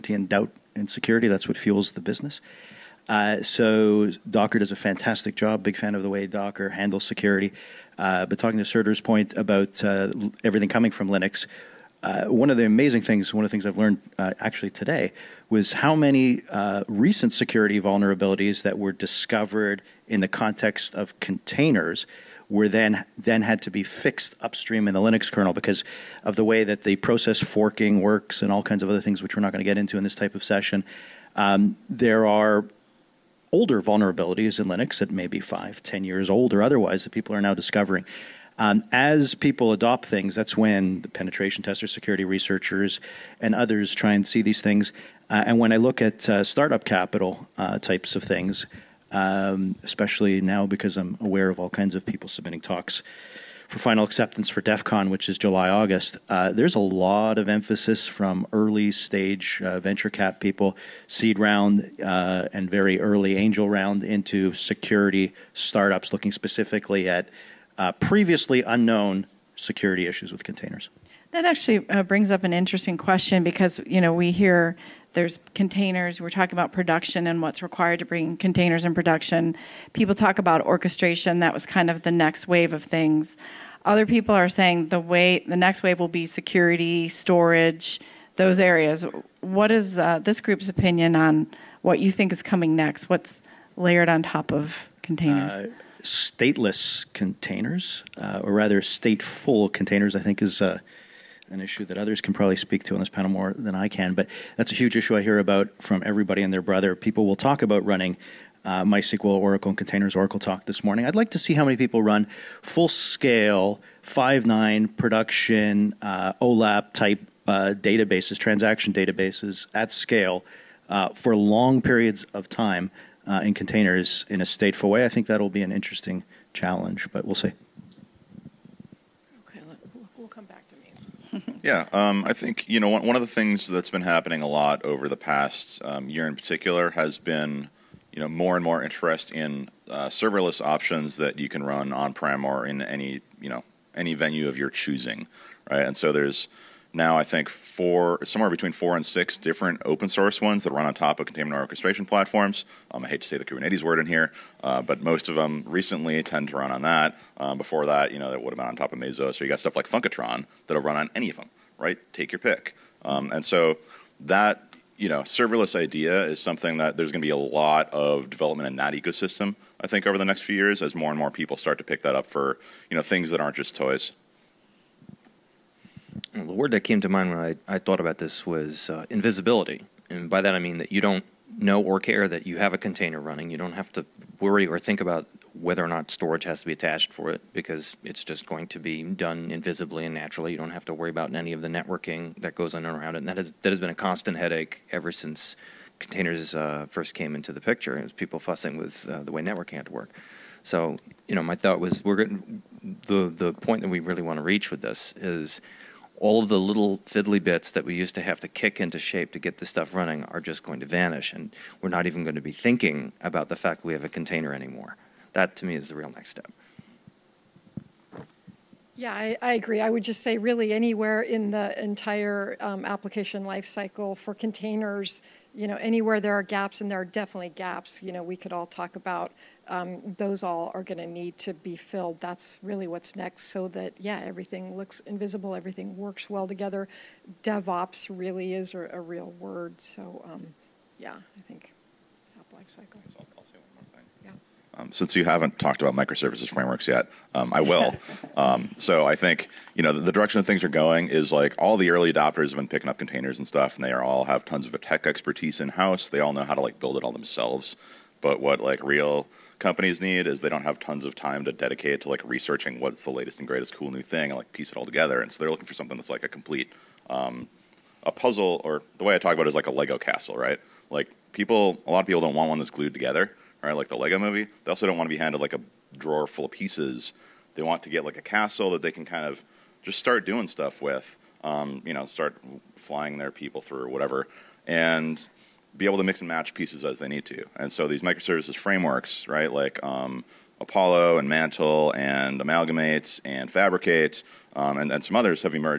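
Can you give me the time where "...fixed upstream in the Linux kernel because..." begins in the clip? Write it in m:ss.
0:23.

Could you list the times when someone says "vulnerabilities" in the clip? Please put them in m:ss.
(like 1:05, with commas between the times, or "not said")
0:17, 0:33.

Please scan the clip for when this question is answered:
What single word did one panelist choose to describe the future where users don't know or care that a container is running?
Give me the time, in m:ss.
2:59.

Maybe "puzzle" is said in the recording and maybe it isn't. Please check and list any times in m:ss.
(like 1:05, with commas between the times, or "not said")
4:28.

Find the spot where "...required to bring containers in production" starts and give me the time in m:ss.
1:17.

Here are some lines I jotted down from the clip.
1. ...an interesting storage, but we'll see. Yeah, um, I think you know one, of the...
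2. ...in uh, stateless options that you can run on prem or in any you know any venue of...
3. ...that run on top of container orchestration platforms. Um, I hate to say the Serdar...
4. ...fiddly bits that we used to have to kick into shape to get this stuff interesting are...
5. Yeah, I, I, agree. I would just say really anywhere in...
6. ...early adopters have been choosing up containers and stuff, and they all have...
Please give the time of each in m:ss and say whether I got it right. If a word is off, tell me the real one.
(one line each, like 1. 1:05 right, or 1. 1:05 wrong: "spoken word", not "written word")
1. 2:05 wrong: "challenge", not "storage"
2. 2:19 wrong: "serverless", not "stateless"
3. 2:30 wrong: "Kubernetes", not "Serdar"
4. 3:26 wrong: "running", not "interesting"
5. 3:38 right
6. 4:11 wrong: "picking", not "choosing".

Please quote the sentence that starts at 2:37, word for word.
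Um, before that, you know, that would have been on top of Mesos.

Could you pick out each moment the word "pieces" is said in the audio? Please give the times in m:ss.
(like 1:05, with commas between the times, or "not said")
4:24, 4:36, 4:46.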